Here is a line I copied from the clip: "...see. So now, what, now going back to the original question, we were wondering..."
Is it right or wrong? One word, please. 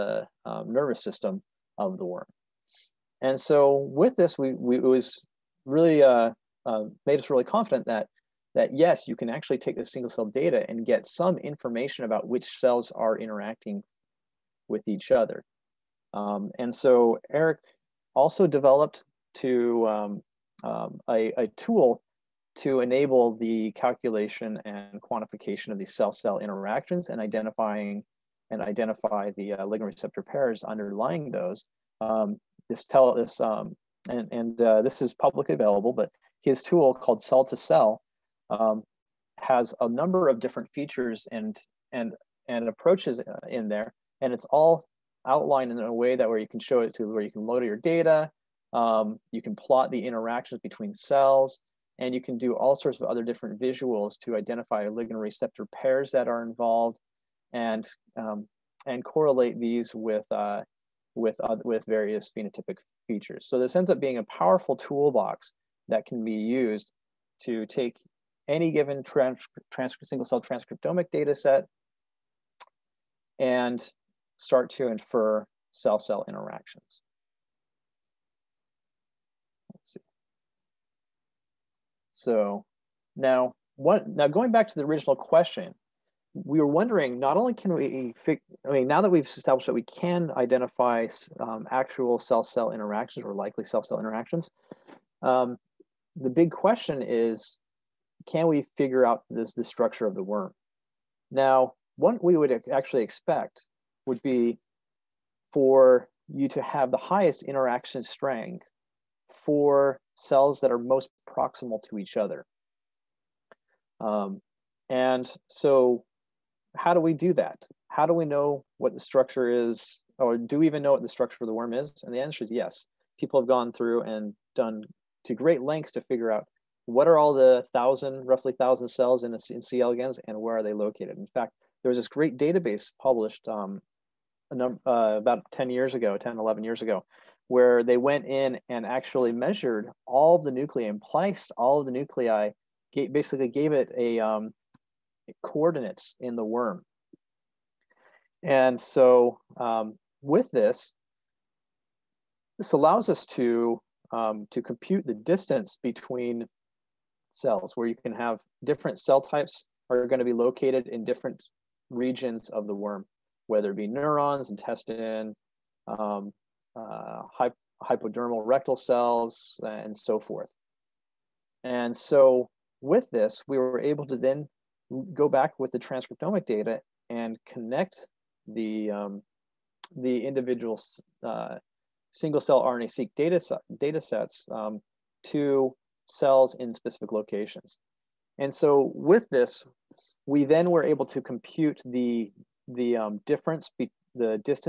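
right.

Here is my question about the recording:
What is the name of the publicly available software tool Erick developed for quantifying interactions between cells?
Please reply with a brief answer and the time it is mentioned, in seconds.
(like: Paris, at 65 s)
cell2cell, at 37 s.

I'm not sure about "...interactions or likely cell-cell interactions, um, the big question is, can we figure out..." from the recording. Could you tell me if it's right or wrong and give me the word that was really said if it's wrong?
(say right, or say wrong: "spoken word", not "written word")
right.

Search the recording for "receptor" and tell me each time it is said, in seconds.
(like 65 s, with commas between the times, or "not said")
29 s, 55 s.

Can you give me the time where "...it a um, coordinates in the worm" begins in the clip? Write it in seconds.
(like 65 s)
143 s.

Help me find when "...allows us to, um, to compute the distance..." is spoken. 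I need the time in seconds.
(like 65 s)
152 s.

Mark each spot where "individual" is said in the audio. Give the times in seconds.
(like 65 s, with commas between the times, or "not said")
180 s.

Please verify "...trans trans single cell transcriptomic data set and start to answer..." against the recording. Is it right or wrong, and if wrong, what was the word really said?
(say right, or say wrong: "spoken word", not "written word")
wrong: "infer", not "answer".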